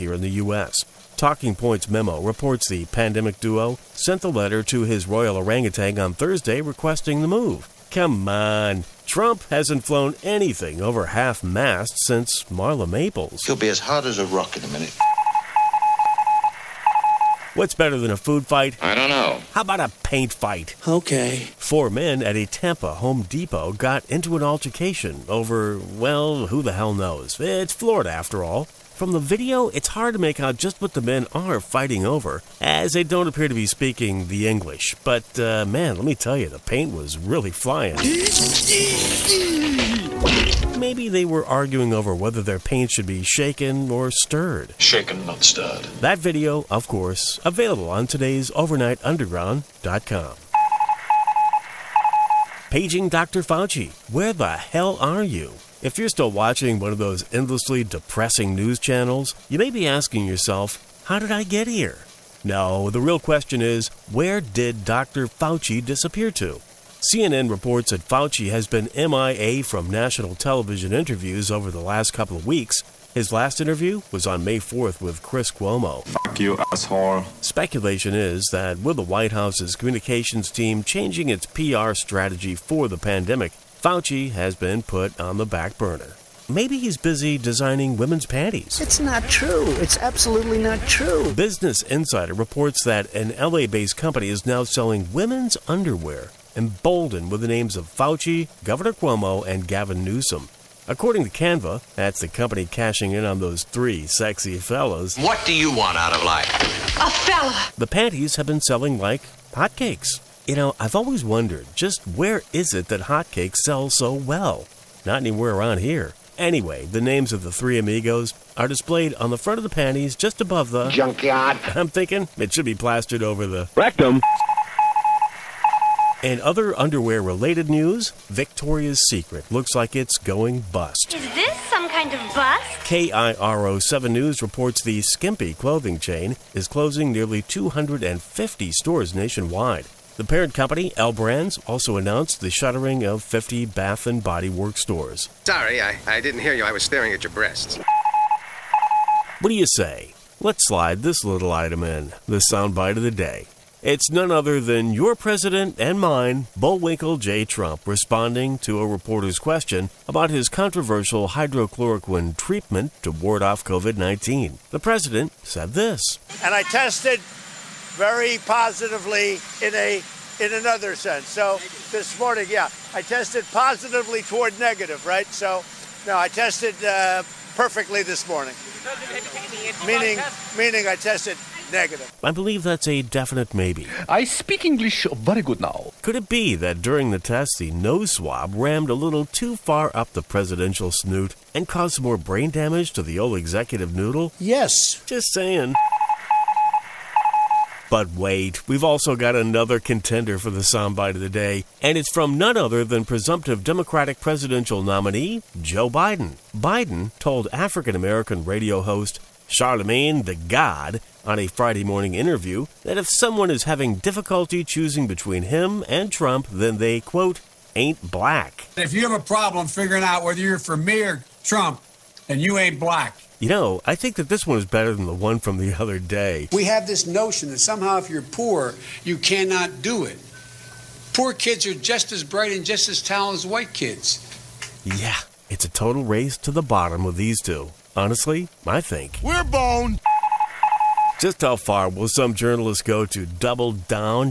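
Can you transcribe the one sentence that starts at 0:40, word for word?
Maybe they were arguing over whether their paint should be shaken or stirred.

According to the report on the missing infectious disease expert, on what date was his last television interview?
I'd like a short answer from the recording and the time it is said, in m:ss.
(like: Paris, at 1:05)
May 4th, at 1:14.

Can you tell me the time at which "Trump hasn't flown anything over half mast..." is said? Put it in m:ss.
0:09.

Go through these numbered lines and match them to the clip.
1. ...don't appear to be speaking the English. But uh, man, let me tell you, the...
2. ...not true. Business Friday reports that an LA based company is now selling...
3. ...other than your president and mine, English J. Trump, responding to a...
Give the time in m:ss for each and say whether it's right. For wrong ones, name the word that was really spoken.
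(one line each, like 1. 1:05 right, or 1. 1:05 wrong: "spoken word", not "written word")
1. 0:33 right
2. 1:30 wrong: "Insider", not "Friday"
3. 2:34 wrong: "Bullwinkle", not "English".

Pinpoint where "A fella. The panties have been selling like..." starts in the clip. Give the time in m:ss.
1:46.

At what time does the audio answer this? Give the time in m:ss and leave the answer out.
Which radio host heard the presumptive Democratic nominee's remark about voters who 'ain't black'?
3:29.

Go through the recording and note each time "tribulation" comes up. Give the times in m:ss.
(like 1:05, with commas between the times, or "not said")
not said.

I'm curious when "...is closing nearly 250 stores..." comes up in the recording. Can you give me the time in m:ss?
2:16.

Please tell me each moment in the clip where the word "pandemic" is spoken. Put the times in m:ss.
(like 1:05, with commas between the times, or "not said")
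0:02, 1:22.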